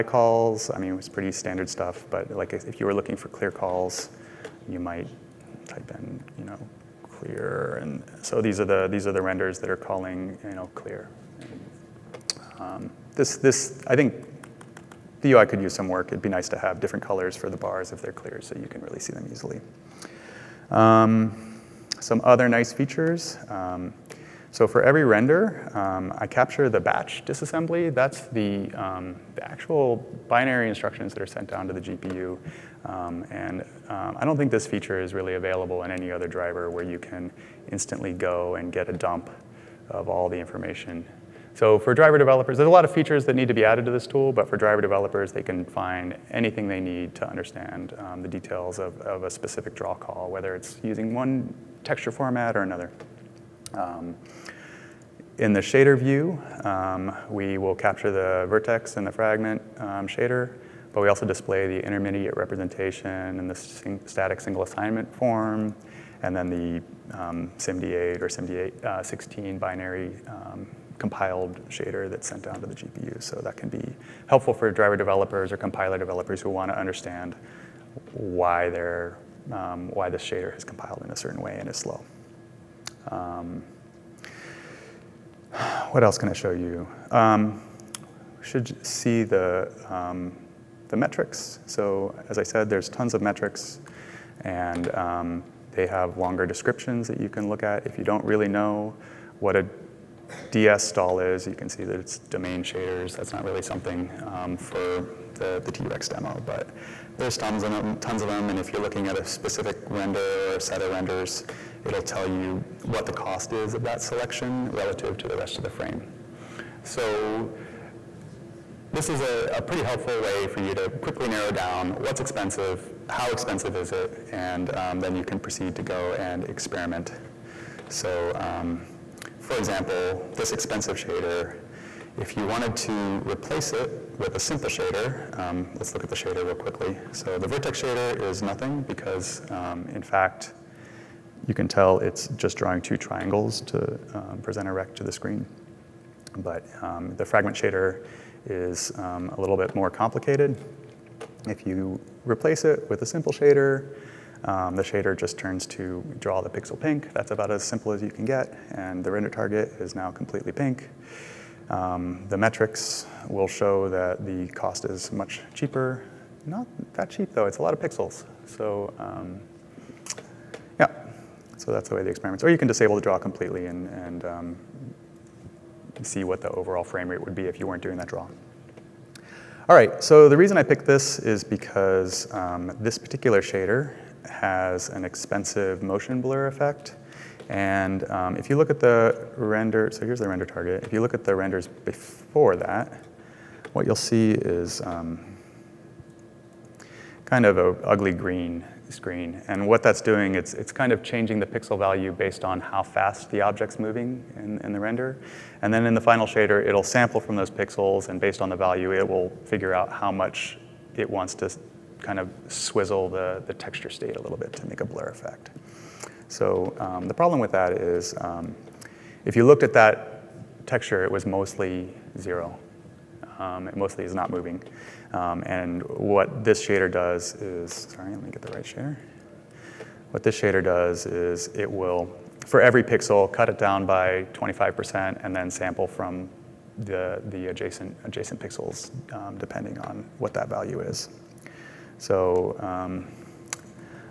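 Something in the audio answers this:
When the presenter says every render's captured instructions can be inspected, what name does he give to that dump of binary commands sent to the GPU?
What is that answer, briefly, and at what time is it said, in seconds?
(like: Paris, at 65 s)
batch disassembly, at 26 s.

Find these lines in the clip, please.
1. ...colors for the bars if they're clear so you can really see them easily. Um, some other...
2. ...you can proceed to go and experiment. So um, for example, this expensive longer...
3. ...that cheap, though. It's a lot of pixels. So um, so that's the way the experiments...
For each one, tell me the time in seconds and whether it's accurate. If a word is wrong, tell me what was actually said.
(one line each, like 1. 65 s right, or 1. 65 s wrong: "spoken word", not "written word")
1. 17 s right
2. 125 s wrong: "shader", not "longer"
3. 166 s right.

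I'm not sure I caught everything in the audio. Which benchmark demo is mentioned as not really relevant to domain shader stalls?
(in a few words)
T-Rex demo.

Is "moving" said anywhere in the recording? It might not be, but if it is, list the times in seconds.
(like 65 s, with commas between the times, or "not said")
203 s, 224 s.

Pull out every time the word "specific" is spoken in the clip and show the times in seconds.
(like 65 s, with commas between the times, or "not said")
49 s, 109 s.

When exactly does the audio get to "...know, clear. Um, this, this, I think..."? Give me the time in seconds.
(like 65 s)
10 s.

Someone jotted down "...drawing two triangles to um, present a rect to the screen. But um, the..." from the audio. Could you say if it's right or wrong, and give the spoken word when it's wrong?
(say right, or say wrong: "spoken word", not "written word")
right.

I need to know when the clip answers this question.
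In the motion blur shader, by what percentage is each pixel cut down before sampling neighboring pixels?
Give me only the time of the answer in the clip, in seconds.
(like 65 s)
234 s.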